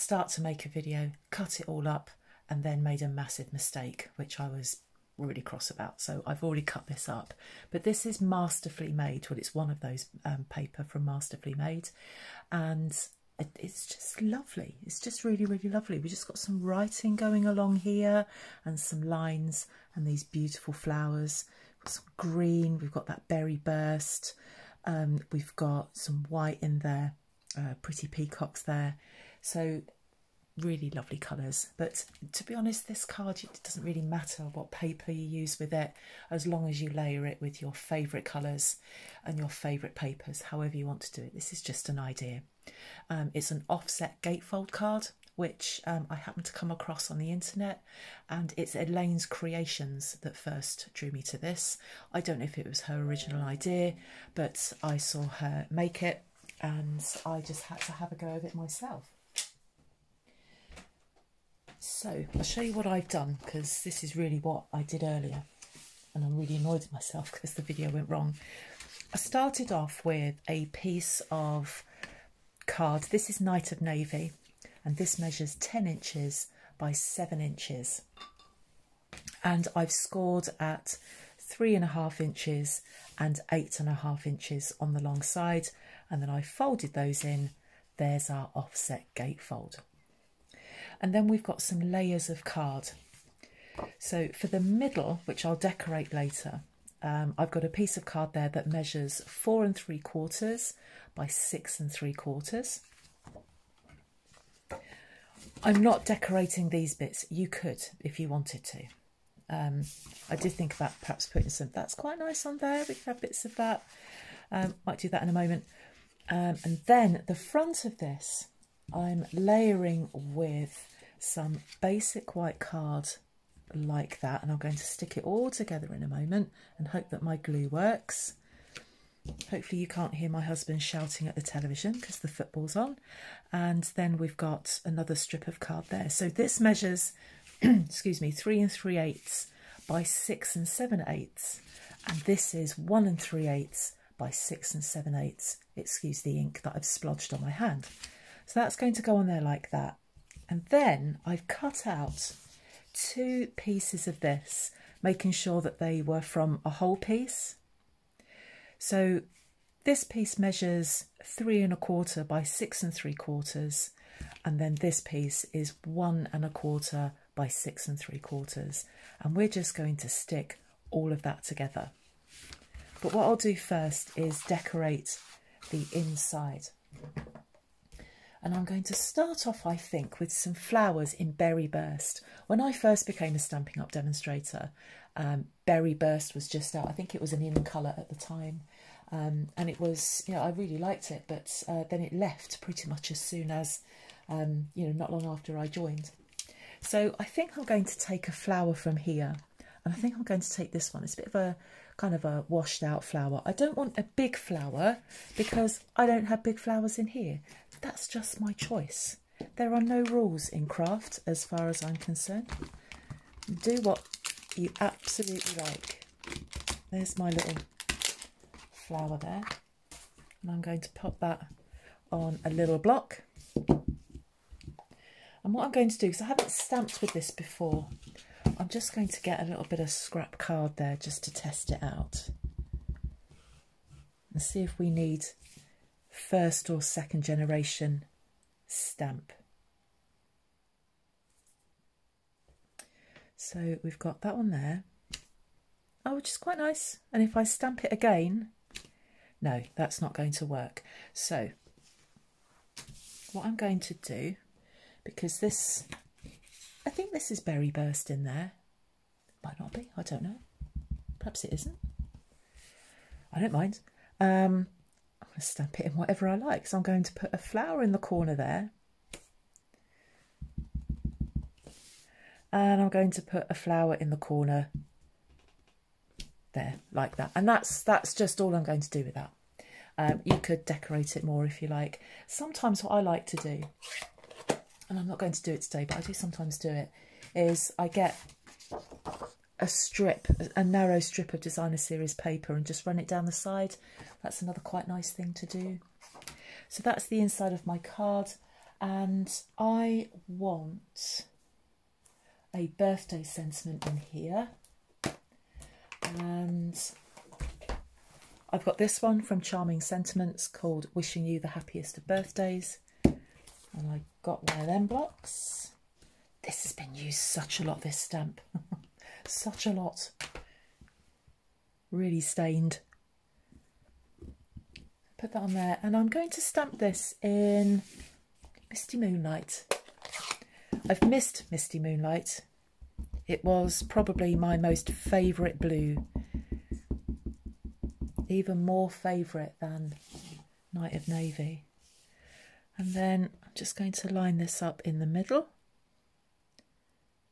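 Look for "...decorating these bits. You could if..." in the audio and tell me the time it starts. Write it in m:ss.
1:46.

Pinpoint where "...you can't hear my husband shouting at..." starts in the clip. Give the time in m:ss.
2:09.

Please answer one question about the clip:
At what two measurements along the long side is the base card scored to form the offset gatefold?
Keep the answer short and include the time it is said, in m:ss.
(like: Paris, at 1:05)
3 1/2 and 8 1/2 inches, at 1:21.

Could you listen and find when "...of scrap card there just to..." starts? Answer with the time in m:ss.
3:49.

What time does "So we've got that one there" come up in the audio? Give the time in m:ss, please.
4:03.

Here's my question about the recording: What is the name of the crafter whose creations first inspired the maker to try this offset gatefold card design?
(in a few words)
Elaine's Creations.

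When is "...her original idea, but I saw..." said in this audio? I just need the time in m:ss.
0:52.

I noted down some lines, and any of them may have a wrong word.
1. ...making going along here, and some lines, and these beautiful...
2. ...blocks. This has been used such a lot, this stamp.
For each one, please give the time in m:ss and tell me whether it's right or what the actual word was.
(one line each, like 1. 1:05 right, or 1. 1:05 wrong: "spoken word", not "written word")
1. 0:16 wrong: "writing", not "making"
2. 5:14 right.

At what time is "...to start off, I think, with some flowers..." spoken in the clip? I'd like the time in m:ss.
2:58.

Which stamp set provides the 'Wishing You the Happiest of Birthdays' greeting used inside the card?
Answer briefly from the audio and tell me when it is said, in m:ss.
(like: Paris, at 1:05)
Charming Sentiments, at 5:09.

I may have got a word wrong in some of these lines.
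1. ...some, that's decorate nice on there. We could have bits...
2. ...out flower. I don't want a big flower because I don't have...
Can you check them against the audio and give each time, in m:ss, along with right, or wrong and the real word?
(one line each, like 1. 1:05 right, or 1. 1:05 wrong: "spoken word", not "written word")
1. 1:51 wrong: "quite", not "decorate"
2. 3:22 right.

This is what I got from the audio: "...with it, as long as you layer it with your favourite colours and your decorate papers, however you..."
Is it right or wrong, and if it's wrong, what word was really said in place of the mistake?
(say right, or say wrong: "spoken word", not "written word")
wrong: "favourite", not "decorate".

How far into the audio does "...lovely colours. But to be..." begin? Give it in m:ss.
0:30.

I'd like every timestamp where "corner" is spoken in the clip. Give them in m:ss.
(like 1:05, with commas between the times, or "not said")
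4:27, 4:34.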